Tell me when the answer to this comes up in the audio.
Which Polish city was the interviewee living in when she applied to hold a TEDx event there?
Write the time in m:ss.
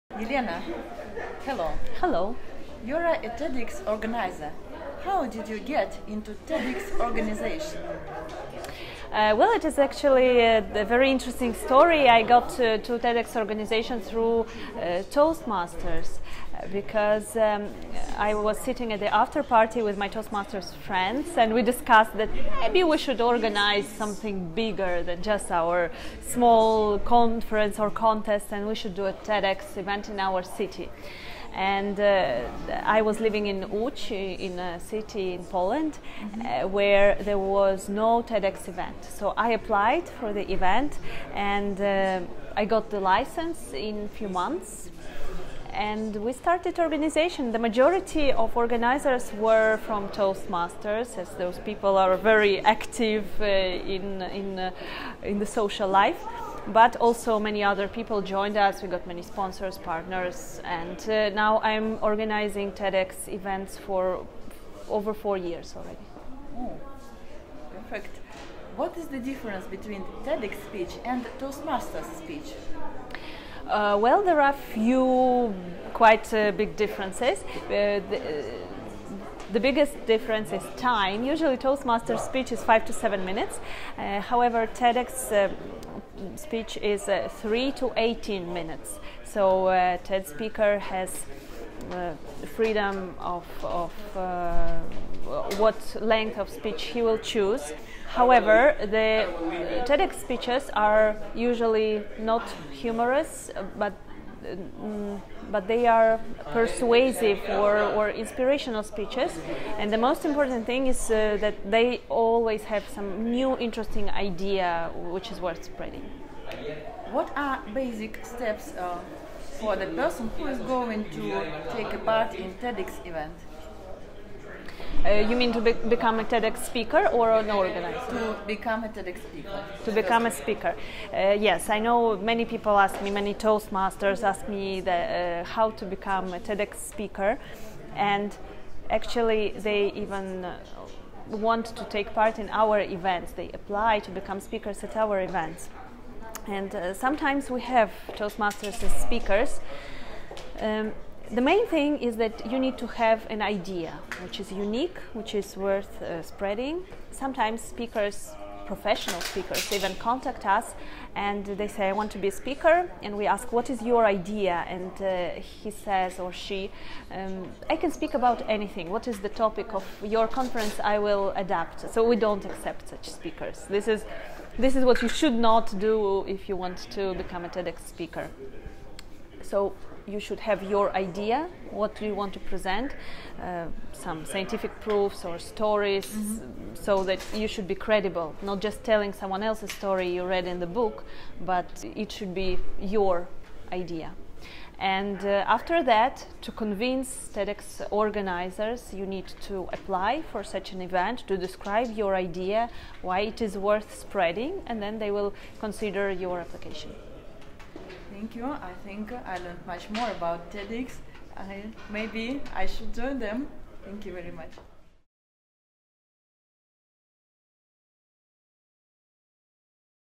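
0:33.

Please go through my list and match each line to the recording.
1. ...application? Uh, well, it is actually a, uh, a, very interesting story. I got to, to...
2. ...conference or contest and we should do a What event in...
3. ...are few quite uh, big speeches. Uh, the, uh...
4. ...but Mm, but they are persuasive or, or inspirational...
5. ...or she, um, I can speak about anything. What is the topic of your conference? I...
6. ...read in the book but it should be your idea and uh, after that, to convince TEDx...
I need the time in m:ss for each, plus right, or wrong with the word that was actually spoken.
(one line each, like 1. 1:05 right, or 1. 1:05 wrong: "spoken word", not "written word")
1. 0:06 wrong: "organization", not "application"
2. 0:26 wrong: "TEDx", not "What"
3. 1:14 wrong: "differences", not "speeches"
4. 1:43 right
5. 2:46 right
6. 3:10 right.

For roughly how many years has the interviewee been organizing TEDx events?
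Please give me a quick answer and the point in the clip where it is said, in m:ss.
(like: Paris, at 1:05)
4 years, at 1:05.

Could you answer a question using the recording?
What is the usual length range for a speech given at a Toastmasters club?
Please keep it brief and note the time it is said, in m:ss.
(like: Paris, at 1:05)
5 to 7 minutes, at 1:22.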